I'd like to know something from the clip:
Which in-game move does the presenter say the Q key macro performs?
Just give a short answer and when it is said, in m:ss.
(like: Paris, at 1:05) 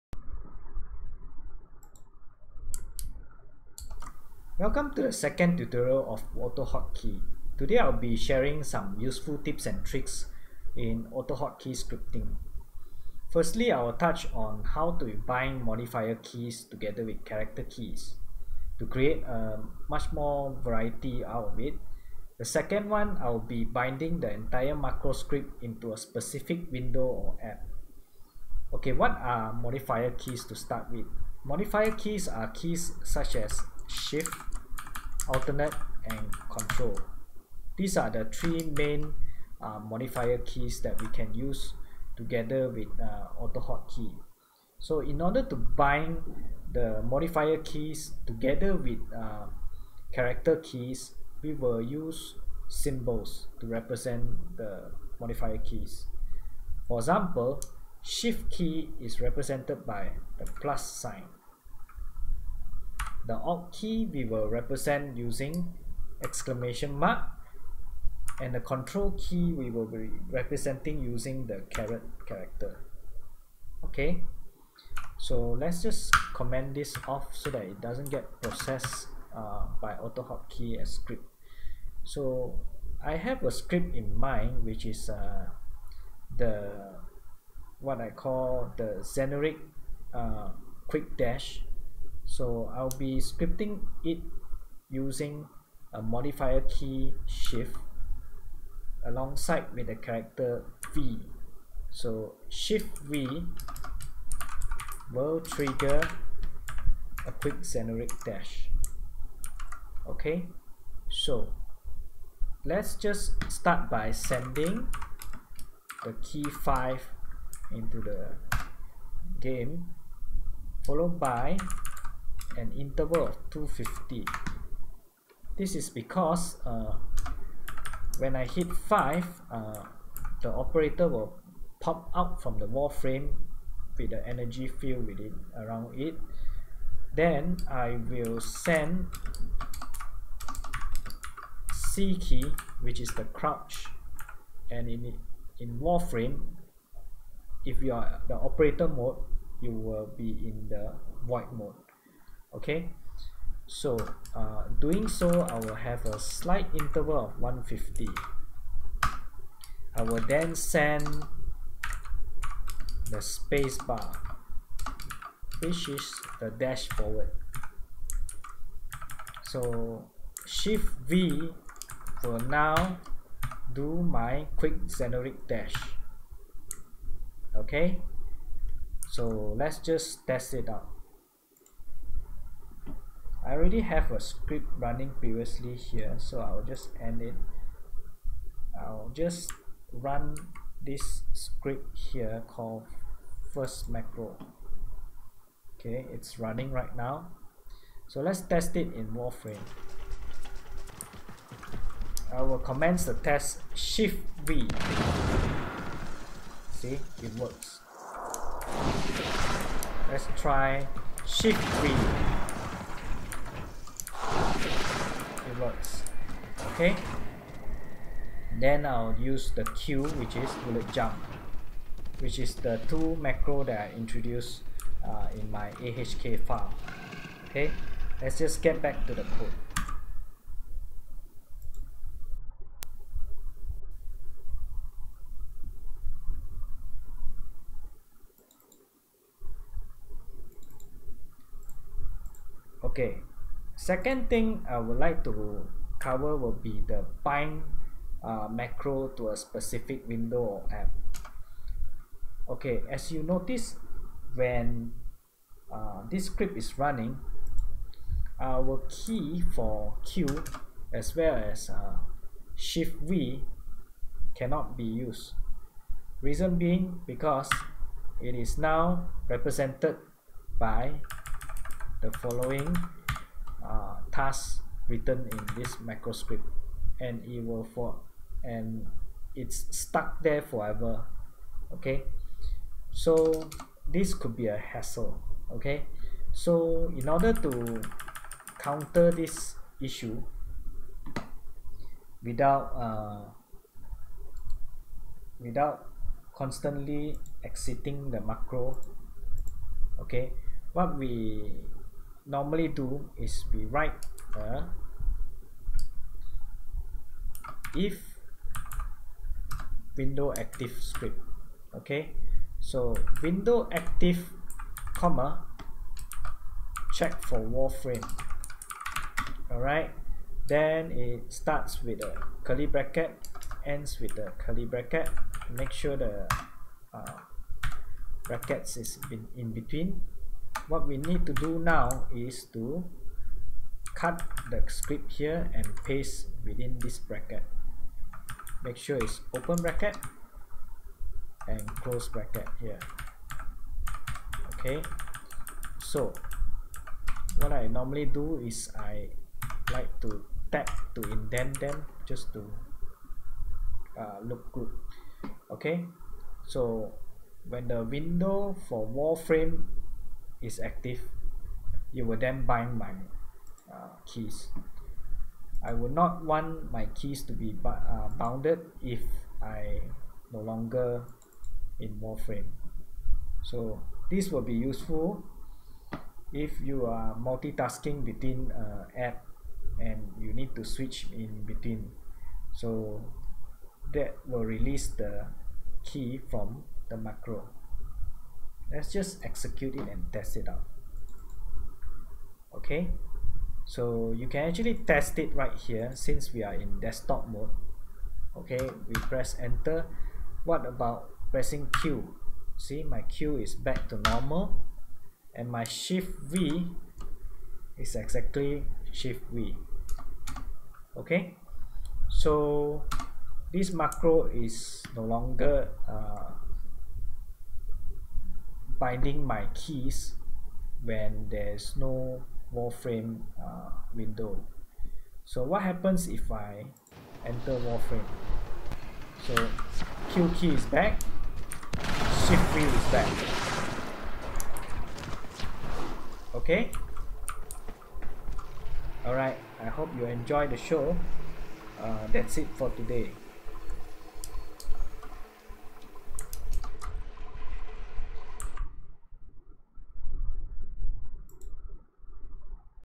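Bullet jump, at 3:40.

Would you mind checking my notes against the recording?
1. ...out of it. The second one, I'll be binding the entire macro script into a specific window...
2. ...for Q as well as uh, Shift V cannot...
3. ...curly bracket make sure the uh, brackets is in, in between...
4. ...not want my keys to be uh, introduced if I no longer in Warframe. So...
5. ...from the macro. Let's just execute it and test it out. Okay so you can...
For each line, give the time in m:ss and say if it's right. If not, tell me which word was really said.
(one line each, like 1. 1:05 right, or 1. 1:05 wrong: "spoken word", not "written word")
1. 0:21 right
2. 4:19 right
3. 5:24 right
4. 6:05 wrong: "bounded", not "introduced"
5. 6:26 right.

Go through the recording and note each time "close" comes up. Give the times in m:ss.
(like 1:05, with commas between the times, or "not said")
5:41.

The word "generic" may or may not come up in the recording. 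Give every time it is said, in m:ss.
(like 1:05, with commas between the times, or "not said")
1:29, 1:47, 2:54.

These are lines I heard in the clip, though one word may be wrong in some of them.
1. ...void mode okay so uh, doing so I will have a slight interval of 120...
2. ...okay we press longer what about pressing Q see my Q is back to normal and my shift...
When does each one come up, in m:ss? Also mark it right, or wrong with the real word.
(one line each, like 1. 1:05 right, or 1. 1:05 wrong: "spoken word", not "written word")
1. 2:31 wrong: "150", not "120"
2. 6:38 wrong: "enter", not "longer".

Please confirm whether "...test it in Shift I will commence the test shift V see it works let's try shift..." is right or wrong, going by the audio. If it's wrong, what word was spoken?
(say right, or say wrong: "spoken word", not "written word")
wrong: "Warframe", not "Shift".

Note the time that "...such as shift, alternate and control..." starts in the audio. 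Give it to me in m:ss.
0:33.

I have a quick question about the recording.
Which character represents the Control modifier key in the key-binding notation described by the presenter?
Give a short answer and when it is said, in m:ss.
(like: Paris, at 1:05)
Caret, at 1:11.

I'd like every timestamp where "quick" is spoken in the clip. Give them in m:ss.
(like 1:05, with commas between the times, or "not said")
1:30, 1:47, 2:54.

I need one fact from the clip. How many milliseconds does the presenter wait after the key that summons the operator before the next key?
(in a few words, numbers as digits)
250.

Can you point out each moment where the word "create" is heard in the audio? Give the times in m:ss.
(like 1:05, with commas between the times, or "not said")
0:18.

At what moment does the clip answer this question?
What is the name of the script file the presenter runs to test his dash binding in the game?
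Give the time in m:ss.
3:13.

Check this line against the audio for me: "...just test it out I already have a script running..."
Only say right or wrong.
right.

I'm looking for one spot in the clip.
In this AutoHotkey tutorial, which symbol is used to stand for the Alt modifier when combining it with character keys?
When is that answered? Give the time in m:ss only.
1:06.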